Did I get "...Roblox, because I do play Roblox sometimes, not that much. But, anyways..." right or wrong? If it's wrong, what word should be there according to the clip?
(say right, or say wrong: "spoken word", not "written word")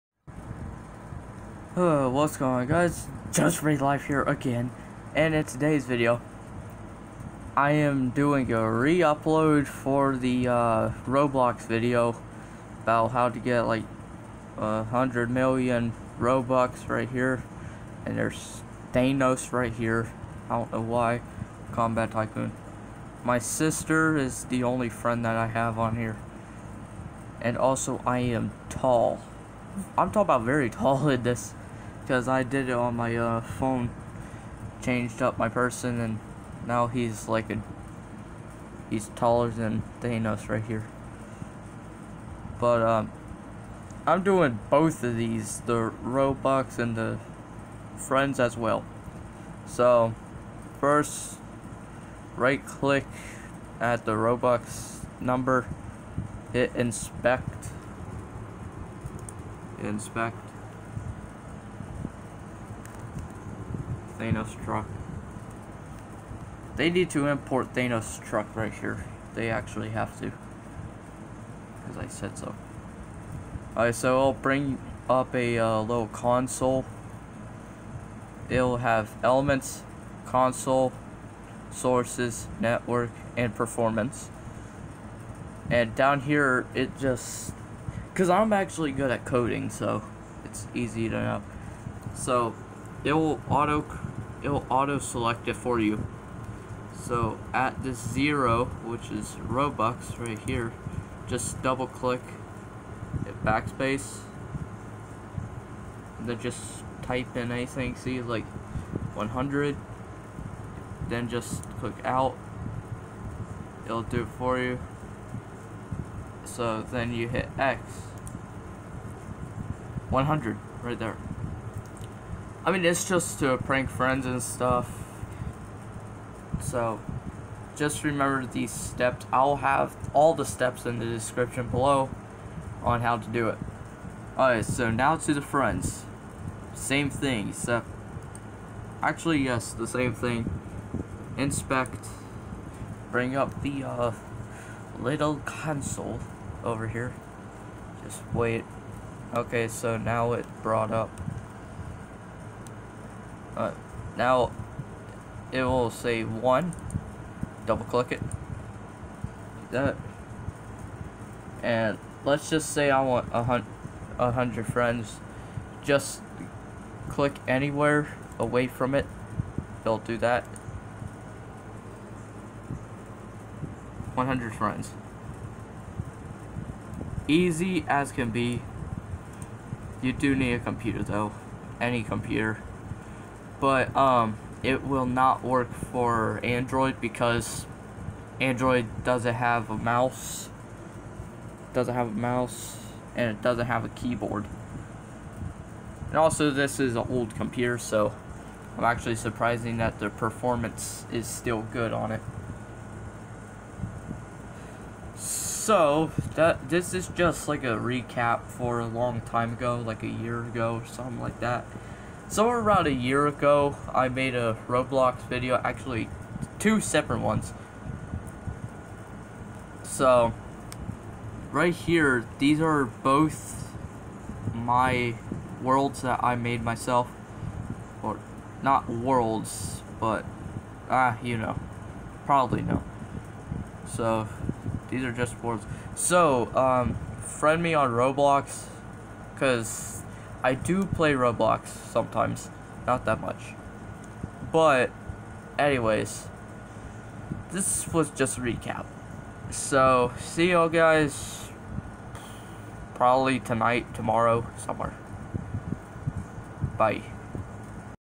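right.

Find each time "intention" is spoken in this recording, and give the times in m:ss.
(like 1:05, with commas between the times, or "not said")
not said.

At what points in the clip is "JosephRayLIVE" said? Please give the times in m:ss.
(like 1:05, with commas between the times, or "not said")
0:03.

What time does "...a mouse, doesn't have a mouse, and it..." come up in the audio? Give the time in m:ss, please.
3:09.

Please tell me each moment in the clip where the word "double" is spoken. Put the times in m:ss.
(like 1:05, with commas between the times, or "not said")
1:41, 2:37.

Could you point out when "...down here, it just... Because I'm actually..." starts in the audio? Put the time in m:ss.
1:25.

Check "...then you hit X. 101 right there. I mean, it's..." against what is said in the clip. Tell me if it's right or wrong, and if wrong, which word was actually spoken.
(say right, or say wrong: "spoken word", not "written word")
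wrong: "100", not "101".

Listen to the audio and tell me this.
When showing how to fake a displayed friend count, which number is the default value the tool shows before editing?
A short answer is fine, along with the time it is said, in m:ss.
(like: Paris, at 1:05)
1, at 2:36.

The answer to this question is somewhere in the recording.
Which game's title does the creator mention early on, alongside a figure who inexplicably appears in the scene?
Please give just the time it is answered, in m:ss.
0:21.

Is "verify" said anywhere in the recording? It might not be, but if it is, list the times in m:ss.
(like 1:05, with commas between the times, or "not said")
not said.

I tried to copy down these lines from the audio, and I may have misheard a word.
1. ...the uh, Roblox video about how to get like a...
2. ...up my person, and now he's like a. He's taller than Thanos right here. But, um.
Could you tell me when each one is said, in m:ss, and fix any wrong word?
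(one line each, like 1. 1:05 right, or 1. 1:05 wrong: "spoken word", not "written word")
1. 0:10 right
2. 0:35 right.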